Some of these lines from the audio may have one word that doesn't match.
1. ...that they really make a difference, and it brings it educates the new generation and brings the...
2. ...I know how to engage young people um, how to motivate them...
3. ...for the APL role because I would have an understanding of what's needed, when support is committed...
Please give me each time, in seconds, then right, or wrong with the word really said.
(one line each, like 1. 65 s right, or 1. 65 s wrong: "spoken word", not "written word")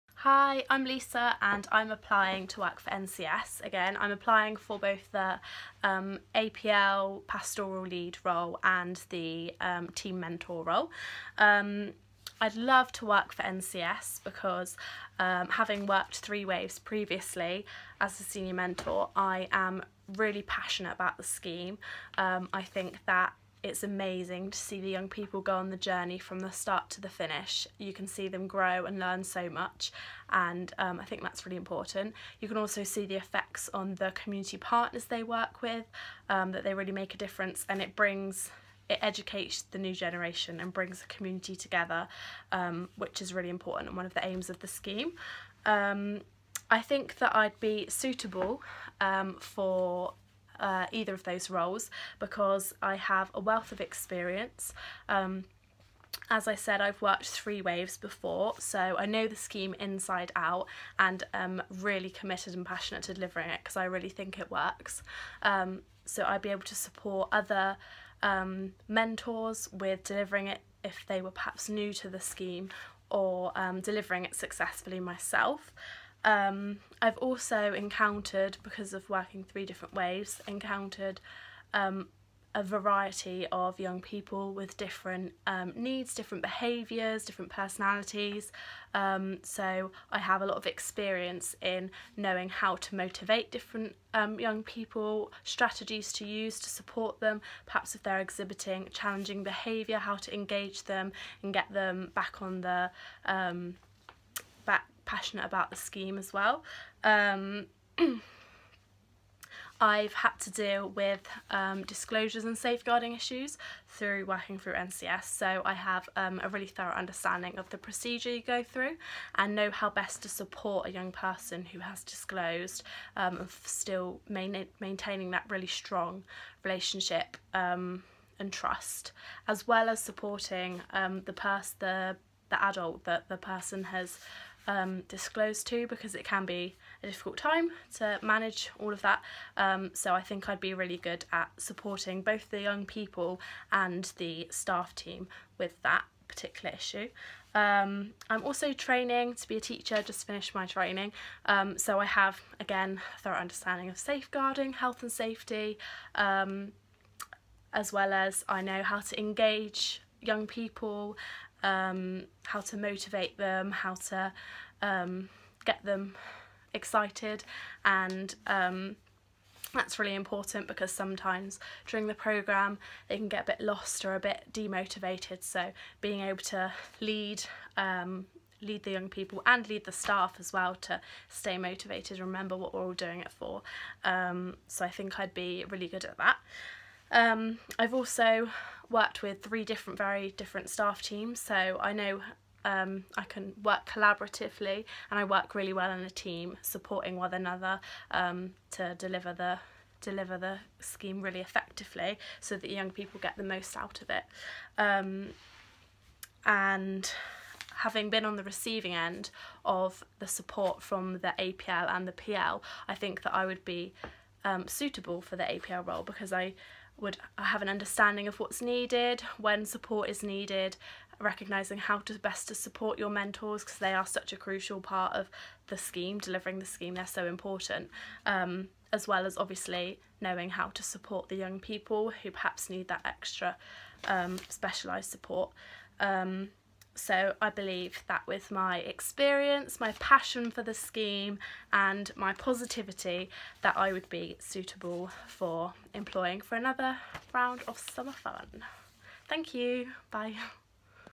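1. 36 s right
2. 158 s right
3. 215 s wrong: "needed", not "committed".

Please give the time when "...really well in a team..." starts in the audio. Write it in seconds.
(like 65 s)
195 s.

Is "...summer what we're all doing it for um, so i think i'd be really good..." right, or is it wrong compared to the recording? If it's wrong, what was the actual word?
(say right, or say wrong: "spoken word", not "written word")
wrong: "remember", not "summer".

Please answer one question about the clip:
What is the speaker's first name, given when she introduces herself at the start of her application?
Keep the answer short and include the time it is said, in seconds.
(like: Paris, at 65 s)
Lisa, at 0 s.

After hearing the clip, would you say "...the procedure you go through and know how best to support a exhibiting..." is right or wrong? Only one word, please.
wrong.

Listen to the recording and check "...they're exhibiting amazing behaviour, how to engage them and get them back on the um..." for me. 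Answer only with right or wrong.
wrong.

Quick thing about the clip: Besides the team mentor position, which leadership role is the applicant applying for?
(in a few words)
APL pastoral lead.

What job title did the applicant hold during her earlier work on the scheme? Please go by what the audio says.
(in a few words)
Senior mentor.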